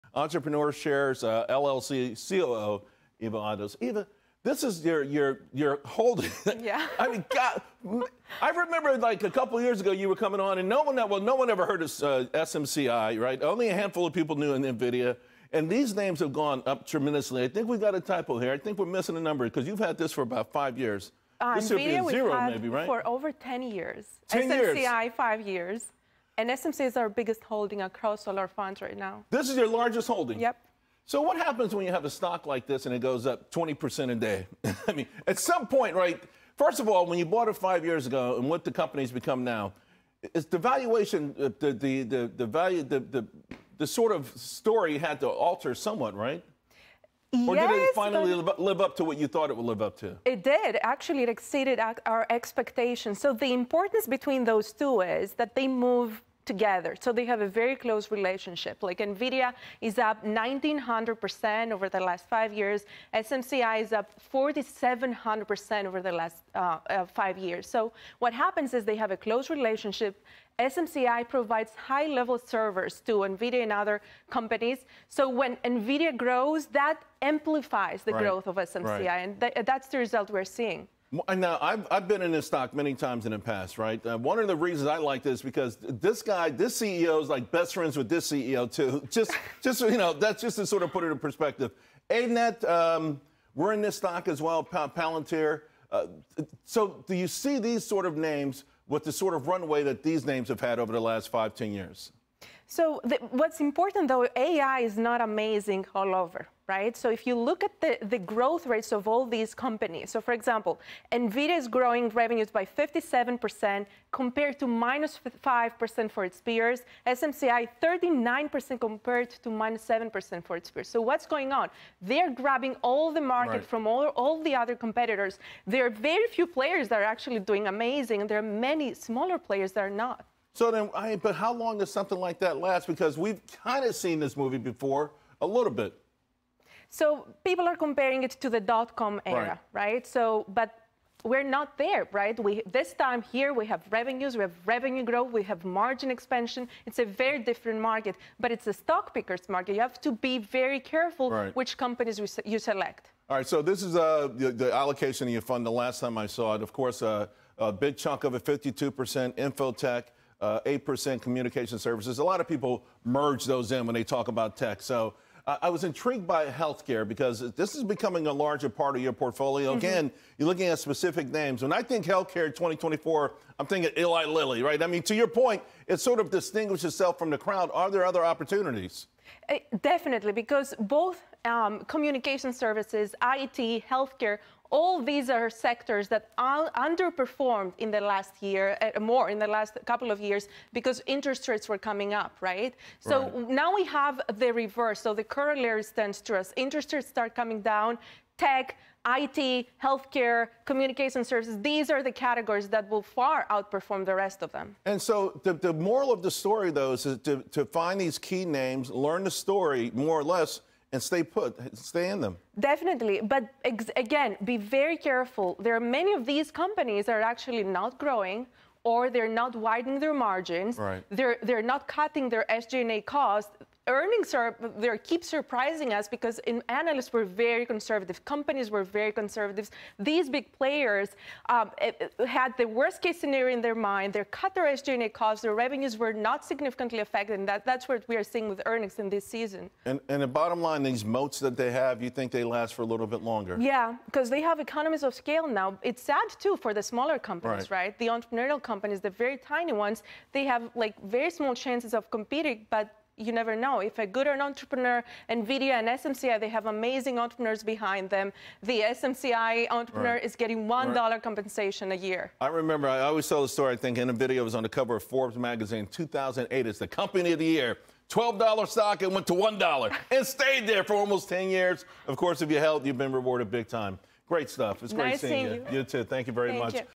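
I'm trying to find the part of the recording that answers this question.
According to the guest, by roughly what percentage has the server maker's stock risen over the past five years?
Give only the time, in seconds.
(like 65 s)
64 s.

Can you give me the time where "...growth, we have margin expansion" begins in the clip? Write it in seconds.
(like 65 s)
145 s.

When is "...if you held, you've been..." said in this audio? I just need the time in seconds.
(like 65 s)
272 s.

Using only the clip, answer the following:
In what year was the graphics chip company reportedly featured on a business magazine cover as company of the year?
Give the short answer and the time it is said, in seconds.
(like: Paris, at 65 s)
2008, at 265 s.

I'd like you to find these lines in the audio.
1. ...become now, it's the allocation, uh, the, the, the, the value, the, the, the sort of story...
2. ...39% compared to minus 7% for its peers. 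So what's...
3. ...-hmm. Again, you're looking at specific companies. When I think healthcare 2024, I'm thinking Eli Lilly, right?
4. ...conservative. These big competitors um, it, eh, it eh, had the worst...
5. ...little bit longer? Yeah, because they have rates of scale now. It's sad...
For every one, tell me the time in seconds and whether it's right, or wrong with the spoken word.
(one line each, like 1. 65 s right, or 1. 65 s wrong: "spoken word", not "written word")
1. 39 s wrong: "valuation", not "allocation"
2. 117 s right
3. 169 s wrong: "names", not "companies"
4. 229 s wrong: "players", not "competitors"
5. 242 s wrong: "economies", not "rates".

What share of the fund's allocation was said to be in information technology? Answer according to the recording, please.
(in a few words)
52%.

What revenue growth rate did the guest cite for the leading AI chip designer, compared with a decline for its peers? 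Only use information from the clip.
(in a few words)
57%.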